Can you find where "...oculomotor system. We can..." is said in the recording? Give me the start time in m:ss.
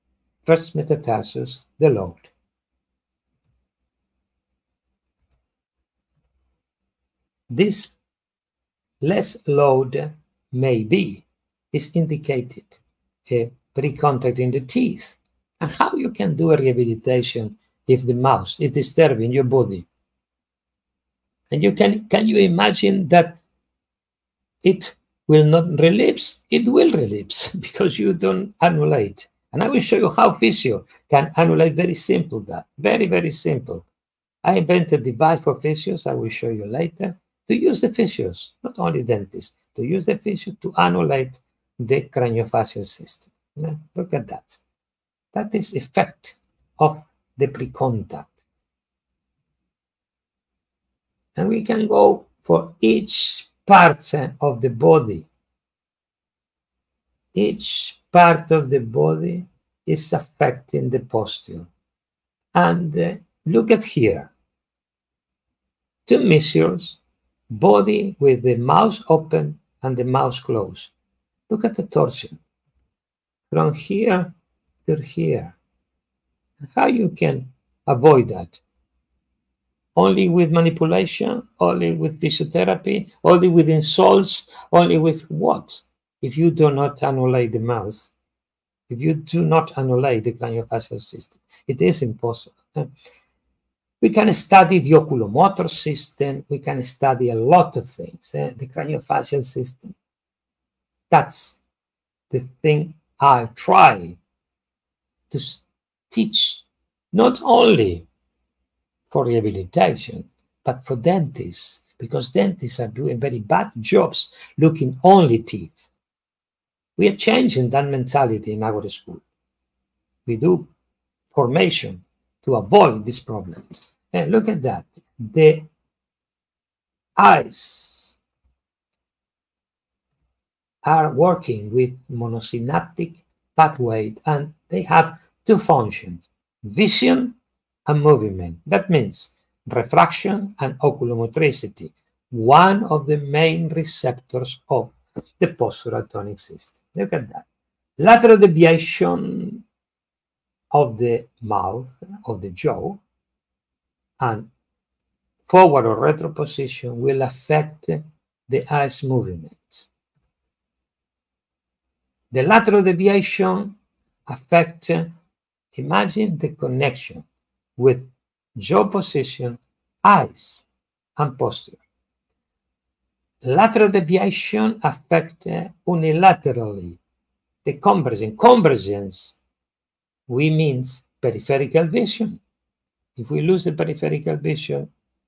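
1:34.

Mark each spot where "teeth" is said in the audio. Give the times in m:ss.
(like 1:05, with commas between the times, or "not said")
0:14, 1:55.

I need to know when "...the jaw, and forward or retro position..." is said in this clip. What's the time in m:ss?
2:32.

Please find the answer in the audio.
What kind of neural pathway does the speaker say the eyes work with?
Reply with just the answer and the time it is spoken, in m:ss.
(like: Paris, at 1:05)
Monosynaptic pathway, at 2:12.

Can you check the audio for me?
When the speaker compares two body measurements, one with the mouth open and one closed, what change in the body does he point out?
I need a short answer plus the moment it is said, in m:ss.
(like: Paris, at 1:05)
Torsion, at 1:11.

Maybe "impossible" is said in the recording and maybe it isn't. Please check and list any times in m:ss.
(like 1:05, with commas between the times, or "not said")
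1:32.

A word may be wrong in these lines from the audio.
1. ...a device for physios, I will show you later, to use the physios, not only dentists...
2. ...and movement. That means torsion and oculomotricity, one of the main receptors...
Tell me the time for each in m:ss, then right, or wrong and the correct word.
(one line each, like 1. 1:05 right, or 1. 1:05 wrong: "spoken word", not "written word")
1. 0:35 right
2. 2:17 wrong: "refraction", not "torsion".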